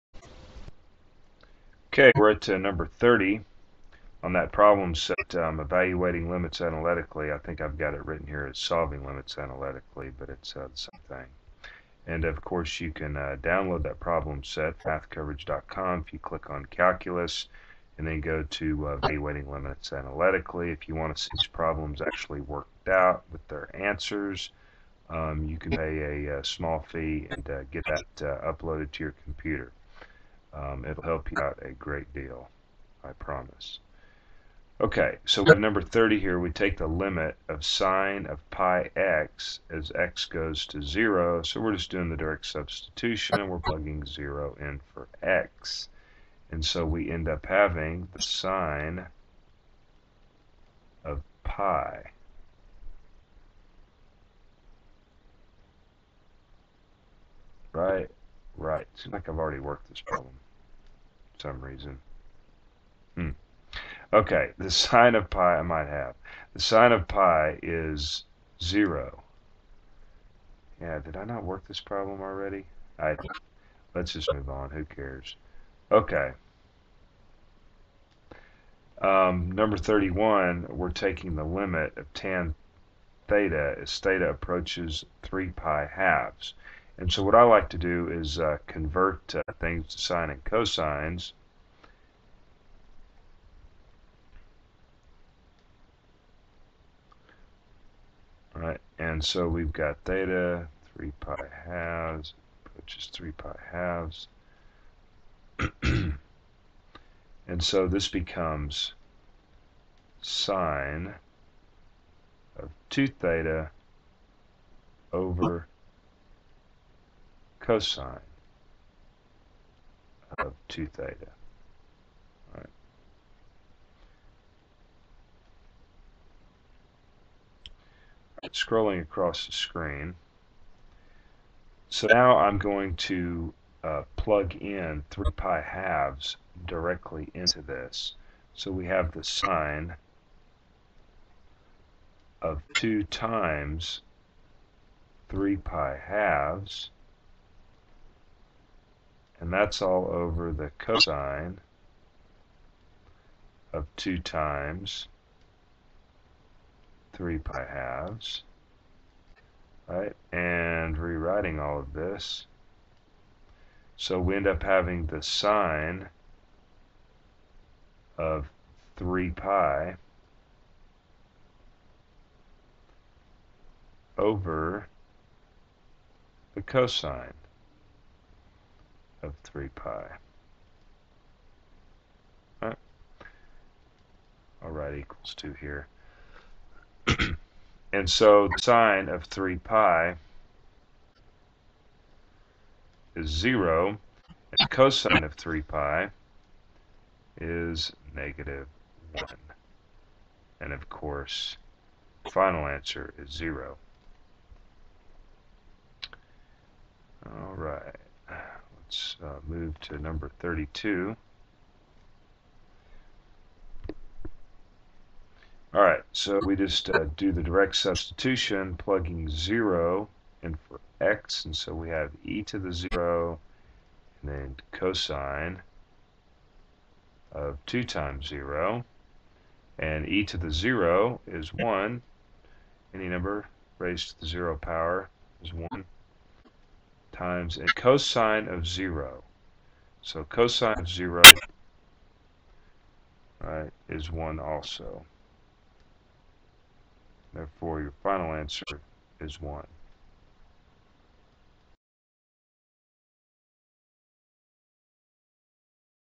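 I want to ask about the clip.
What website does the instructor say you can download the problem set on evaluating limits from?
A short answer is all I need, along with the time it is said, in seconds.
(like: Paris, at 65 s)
mathcoverage.com, at 14 s.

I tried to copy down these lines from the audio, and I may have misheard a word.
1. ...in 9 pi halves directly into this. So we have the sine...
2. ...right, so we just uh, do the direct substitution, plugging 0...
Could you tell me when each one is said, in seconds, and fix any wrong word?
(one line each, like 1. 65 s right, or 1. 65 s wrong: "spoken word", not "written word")
1. 134 s wrong: "3", not "9"
2. 215 s right.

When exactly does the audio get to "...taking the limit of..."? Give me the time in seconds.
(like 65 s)
80 s.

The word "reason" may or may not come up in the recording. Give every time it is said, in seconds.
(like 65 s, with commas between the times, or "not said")
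61 s.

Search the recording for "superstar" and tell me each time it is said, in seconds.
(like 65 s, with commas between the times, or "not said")
not said.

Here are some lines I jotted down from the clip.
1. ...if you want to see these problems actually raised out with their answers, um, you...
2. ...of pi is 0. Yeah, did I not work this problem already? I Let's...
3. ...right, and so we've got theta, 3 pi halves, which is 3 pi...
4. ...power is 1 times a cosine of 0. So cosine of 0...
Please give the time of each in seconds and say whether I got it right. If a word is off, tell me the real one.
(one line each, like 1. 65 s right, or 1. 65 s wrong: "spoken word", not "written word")
1. 20 s wrong: "worked", not "raised"
2. 66 s right
3. 98 s right
4. 234 s right.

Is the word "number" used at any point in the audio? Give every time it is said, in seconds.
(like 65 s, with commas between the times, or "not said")
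2 s, 35 s, 79 s, 209 s, 233 s.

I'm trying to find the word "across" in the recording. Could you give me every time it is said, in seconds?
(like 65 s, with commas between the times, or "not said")
129 s.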